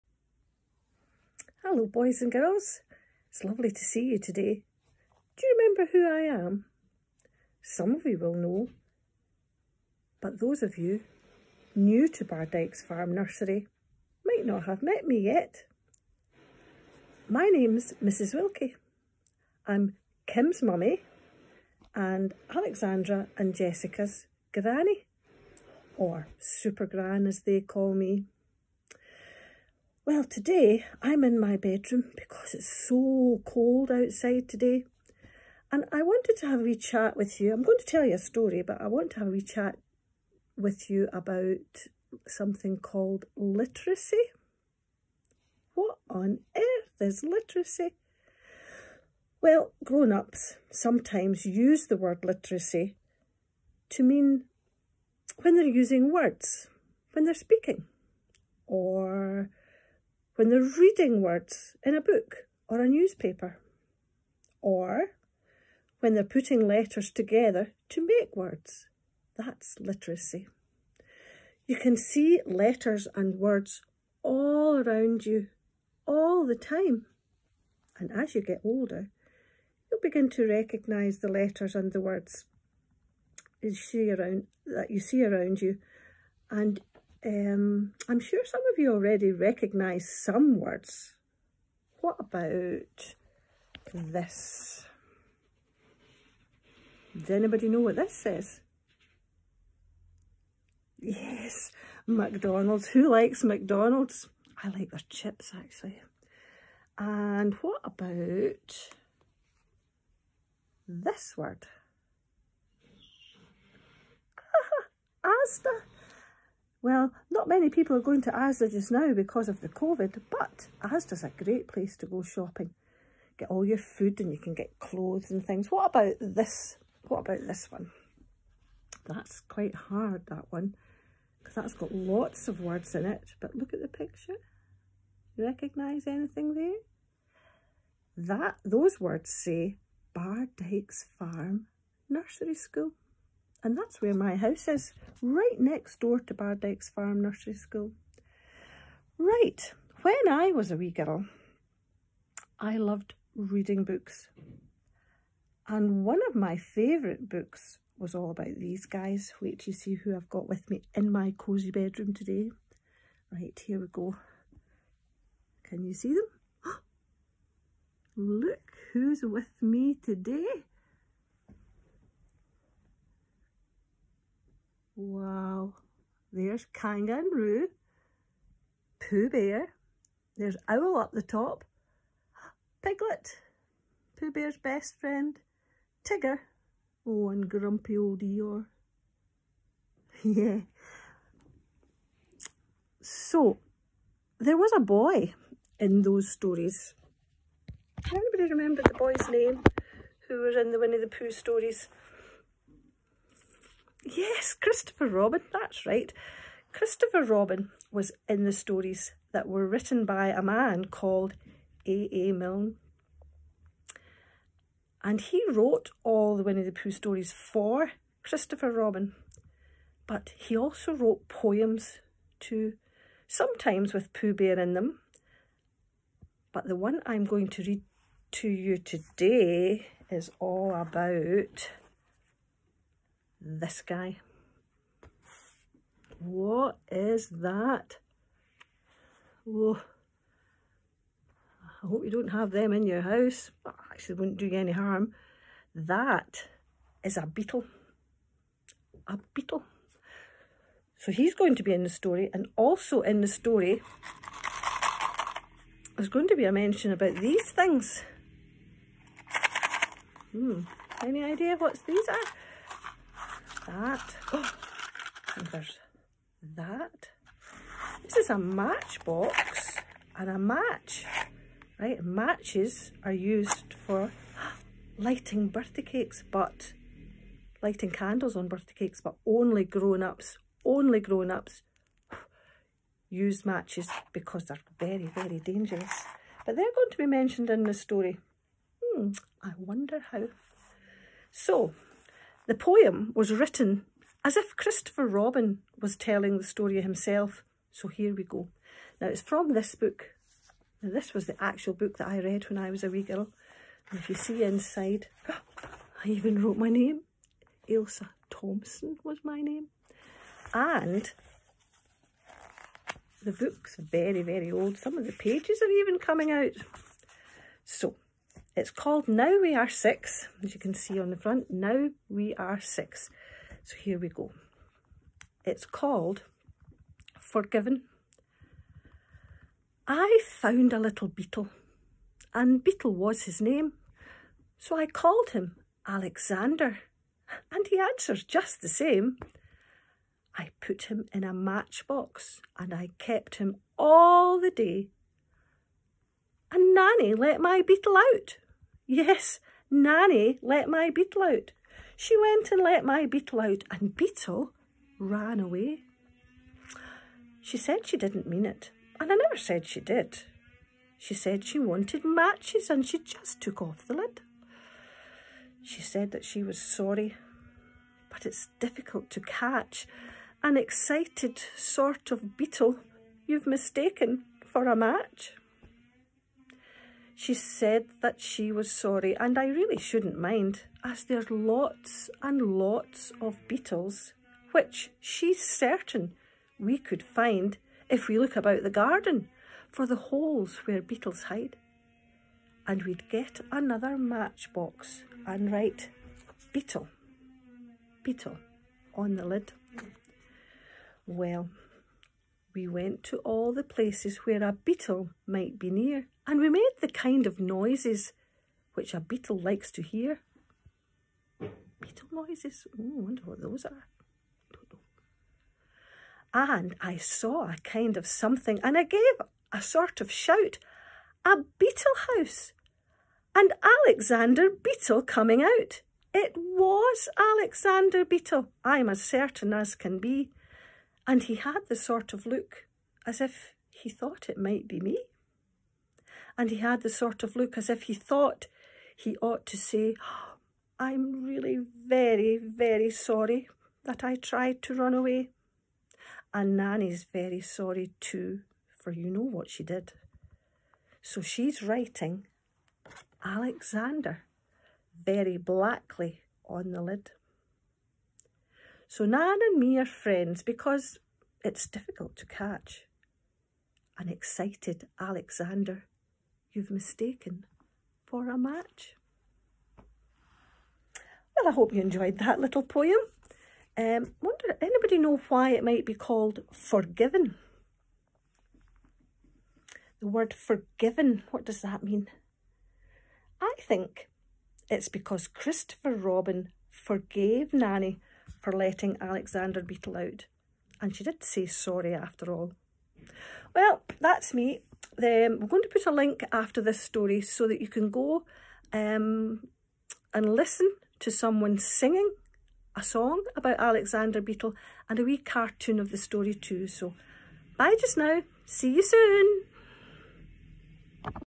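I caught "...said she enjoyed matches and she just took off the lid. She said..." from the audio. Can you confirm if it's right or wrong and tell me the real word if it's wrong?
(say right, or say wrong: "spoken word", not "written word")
wrong: "wanted", not "enjoyed".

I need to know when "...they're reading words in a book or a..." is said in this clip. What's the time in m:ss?
1:00.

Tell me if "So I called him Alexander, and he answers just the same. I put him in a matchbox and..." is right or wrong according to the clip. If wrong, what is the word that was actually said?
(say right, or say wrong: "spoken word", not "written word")
right.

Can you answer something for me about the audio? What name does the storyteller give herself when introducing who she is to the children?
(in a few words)
Mrs Wilkie.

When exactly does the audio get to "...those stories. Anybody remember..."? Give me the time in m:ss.
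3:16.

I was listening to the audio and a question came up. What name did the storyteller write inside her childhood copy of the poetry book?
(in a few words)
Ailsa Thompson.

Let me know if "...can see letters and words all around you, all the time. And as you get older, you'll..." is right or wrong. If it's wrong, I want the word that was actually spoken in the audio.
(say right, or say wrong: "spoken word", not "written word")
right.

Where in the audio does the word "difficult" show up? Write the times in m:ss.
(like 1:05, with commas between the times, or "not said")
6:08, 7:41.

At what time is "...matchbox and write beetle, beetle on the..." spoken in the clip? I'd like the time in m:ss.
6:33.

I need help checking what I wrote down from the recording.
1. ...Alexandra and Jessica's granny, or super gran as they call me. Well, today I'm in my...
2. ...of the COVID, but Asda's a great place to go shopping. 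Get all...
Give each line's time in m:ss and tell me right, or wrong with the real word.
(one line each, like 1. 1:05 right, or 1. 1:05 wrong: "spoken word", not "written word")
1. 0:22 right
2. 1:59 right.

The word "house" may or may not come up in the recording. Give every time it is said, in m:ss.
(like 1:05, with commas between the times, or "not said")
2:24, 4:03, 7:02.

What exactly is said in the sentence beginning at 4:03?
actually, wouldn't do you any harm.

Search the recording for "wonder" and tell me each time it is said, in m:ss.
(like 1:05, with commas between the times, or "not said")
4:49, 6:53, 7:54.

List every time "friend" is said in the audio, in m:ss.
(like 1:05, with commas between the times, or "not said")
3:04, 7:39.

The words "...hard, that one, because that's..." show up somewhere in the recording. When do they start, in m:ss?
2:09.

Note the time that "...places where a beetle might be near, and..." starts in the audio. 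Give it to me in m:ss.
6:43.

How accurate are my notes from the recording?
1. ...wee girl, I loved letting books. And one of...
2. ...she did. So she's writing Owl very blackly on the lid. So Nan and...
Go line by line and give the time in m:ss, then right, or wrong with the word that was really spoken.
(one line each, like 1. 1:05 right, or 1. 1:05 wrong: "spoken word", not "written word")
1. 2:30 wrong: "reading", not "letting"
2. 7:29 wrong: "Alexander", not "Owl".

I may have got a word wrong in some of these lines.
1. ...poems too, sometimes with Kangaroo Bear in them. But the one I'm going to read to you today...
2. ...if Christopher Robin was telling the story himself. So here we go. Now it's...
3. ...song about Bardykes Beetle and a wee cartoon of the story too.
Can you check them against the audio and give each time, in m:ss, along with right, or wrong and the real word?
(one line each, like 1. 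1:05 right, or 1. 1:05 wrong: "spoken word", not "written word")
1. 3:41 wrong: "Pooh", not "Kangaroo"
2. 4:54 right
3. 8:22 wrong: "Alexander", not "Bardykes".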